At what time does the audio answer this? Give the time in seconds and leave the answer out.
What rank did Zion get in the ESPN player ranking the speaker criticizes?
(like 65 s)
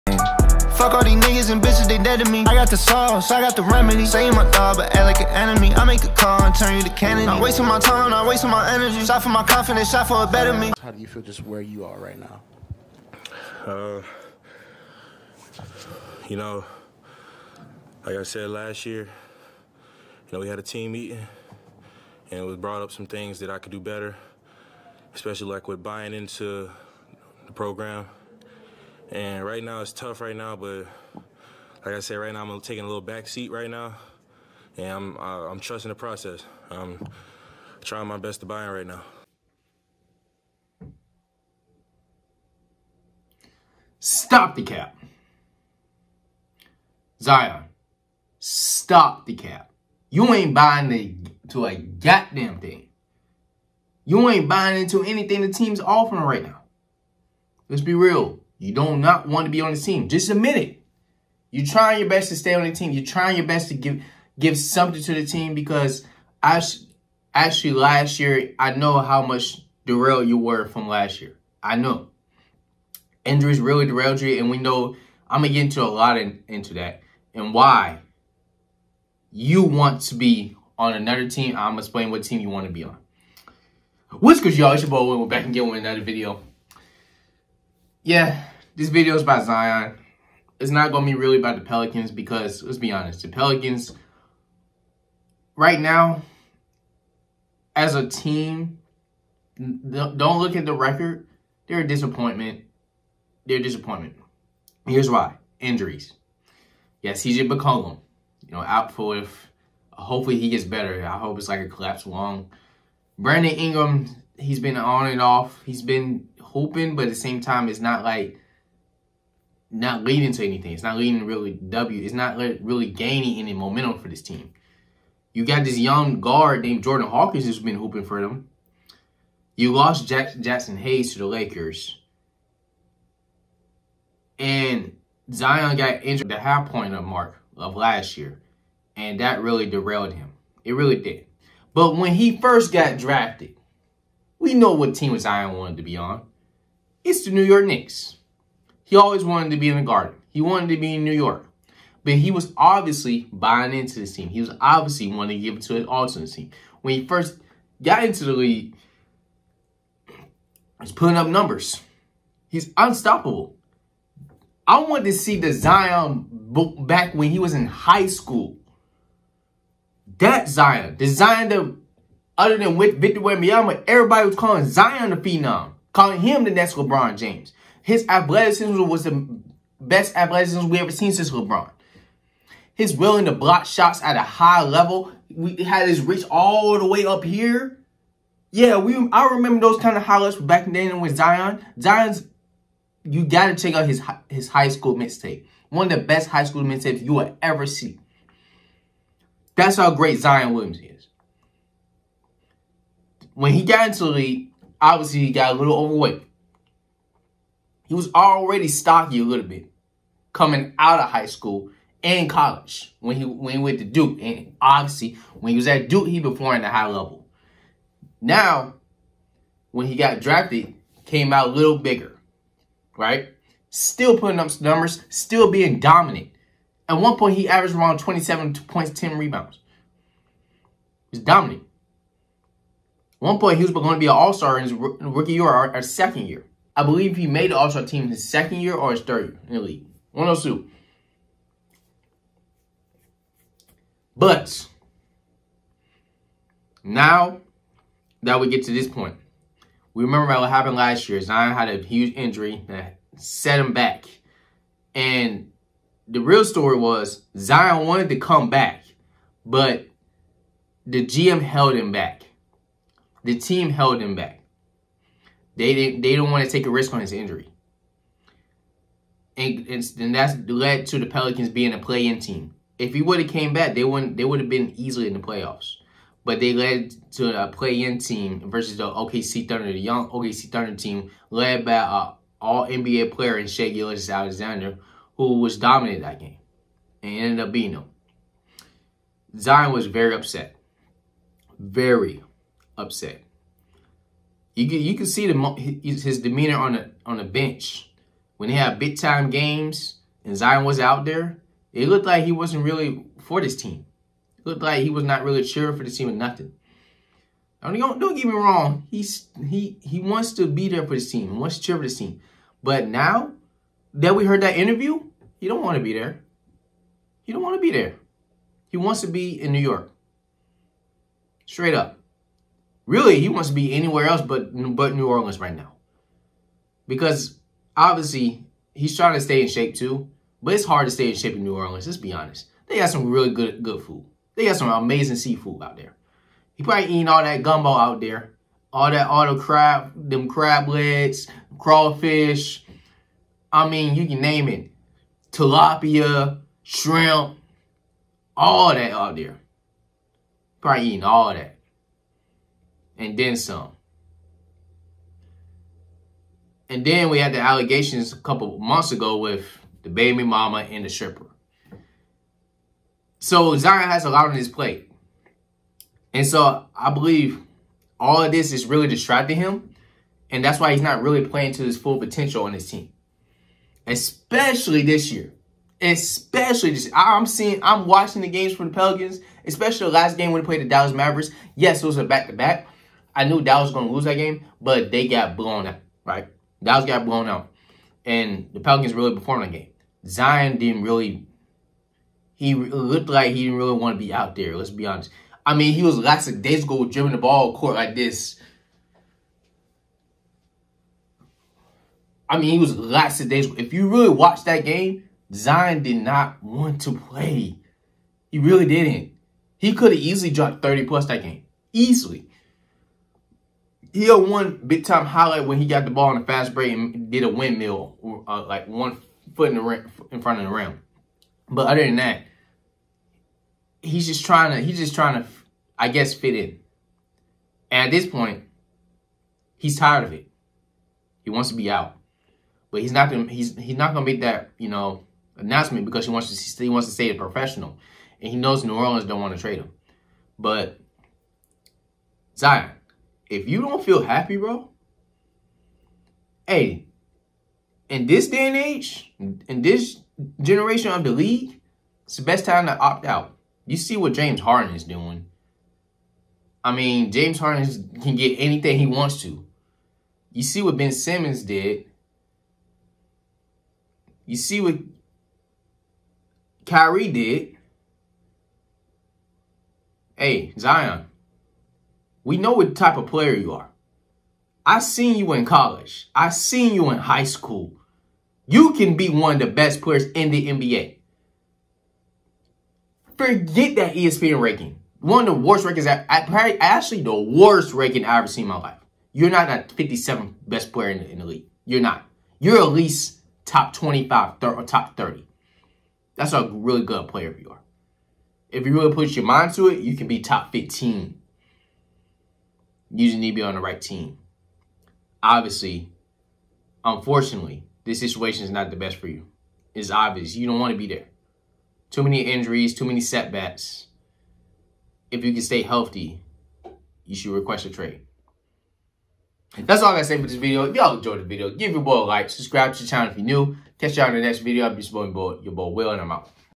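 489 s.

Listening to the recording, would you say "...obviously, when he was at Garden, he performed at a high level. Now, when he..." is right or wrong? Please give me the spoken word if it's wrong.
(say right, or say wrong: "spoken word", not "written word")
wrong: "Duke", not "Garden".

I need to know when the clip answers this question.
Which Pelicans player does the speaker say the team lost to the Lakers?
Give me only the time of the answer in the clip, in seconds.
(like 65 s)
130 s.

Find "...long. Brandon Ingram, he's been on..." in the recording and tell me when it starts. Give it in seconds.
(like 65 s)
112 s.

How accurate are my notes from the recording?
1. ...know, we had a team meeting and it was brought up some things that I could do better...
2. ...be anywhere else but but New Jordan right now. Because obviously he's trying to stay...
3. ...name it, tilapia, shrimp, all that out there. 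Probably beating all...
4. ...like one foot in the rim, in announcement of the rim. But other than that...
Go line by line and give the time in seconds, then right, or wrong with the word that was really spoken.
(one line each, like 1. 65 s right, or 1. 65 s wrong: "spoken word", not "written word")
1. 20 s right
2. 323 s wrong: "Orleans", not "Jordan"
3. 344 s wrong: "eating", not "beating"
4. 418 s wrong: "front", not "announcement".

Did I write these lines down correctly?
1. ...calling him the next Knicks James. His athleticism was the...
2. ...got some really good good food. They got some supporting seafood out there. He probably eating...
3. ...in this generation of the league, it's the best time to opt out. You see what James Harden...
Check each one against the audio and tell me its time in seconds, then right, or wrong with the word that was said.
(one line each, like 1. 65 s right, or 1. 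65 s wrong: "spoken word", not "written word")
1. 175 s wrong: "LeBron", not "Knicks"
2. 332 s wrong: "amazing", not "supporting"
3. 449 s right.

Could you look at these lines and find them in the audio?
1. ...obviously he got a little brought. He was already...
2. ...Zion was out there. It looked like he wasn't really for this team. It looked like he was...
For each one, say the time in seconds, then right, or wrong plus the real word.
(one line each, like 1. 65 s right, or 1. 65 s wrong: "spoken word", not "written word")
1. 204 s wrong: "overweight", not "brought"
2. 300 s right.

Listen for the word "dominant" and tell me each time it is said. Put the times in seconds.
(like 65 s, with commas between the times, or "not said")
225 s, 231 s, 285 s.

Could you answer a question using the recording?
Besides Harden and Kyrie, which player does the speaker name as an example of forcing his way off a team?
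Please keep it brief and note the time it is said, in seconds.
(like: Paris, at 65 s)
Ben Simmons, at 460 s.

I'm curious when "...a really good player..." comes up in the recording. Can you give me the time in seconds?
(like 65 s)
496 s.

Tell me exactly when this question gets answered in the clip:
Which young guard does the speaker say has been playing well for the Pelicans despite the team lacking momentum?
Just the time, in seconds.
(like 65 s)
126 s.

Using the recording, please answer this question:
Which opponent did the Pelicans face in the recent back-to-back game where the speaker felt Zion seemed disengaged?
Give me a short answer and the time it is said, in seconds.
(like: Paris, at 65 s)
Dallas Mavericks, at 380 s.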